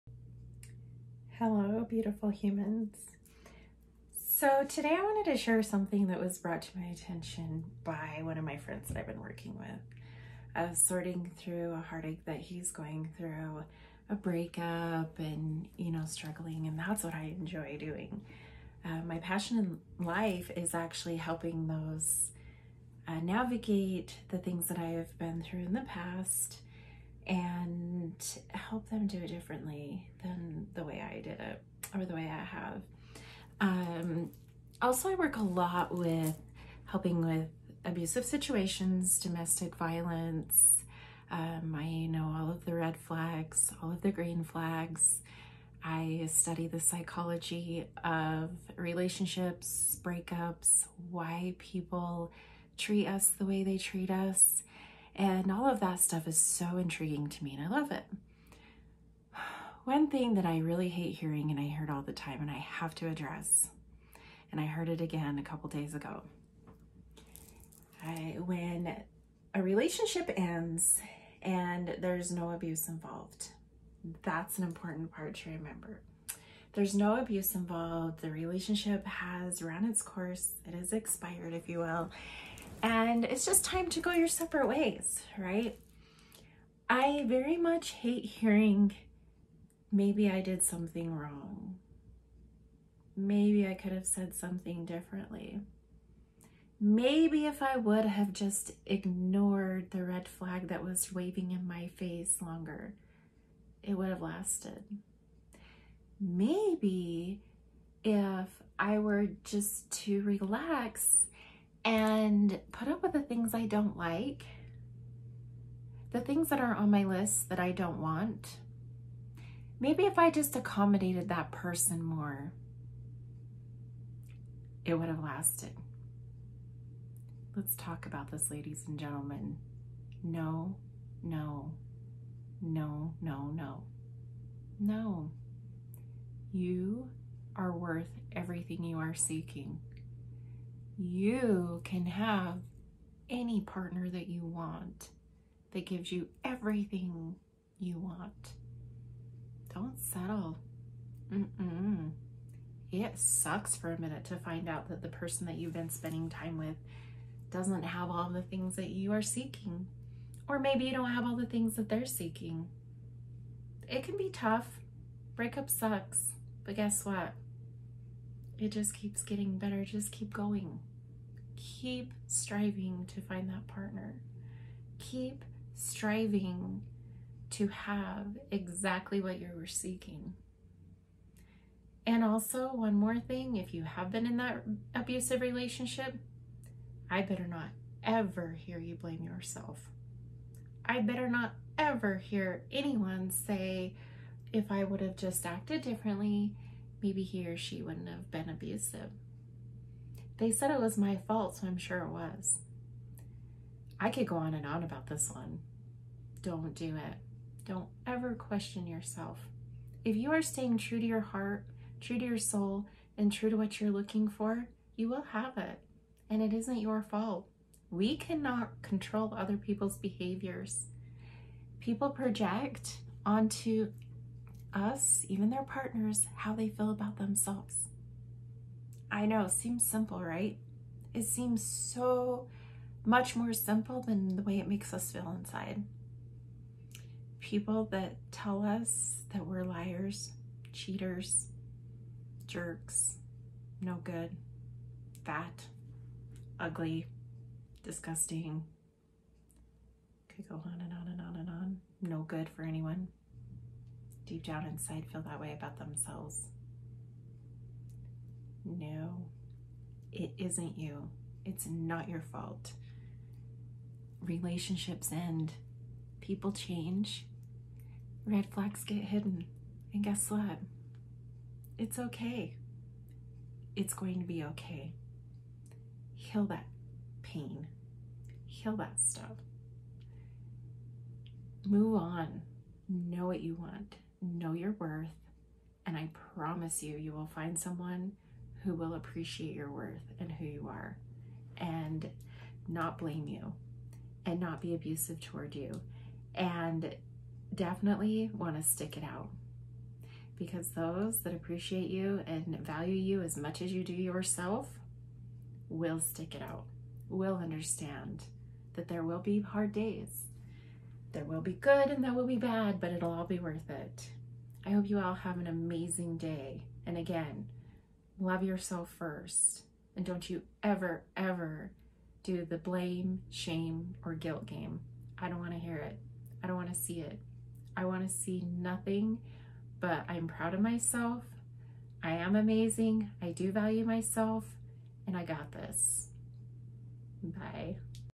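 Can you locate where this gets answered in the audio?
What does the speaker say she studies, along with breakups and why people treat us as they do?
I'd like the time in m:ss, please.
0:46.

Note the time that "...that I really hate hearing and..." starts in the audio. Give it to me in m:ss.
1:00.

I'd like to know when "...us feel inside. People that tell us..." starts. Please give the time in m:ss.
3:54.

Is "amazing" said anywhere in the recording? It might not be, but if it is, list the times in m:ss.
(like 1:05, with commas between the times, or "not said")
5:15, 5:32.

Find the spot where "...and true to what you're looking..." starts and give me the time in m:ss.
3:33.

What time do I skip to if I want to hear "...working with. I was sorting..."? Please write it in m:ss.
0:09.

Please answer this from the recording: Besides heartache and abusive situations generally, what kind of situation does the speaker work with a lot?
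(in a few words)
domestic violence.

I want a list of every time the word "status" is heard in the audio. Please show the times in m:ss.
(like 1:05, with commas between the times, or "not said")
not said.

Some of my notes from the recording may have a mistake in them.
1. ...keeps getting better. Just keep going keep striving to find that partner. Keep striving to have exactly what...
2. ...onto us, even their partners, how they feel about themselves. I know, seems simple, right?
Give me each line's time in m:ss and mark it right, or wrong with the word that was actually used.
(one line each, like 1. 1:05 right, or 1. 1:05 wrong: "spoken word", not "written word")
1. 2:48 right
2. 3:43 right.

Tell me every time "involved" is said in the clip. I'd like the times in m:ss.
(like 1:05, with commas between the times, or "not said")
1:12, 1:17.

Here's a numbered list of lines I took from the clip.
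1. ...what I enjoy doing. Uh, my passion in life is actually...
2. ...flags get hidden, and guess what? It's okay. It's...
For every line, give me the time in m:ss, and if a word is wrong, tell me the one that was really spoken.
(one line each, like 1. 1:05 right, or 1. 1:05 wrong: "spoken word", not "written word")
1. 0:17 right
2. 4:28 right.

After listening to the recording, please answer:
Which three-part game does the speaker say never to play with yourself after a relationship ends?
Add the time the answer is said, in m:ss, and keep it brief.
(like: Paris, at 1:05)
blame, shame, or guilt, at 5:22.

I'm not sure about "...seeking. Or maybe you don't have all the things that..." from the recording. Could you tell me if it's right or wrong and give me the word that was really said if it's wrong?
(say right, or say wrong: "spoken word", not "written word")
right.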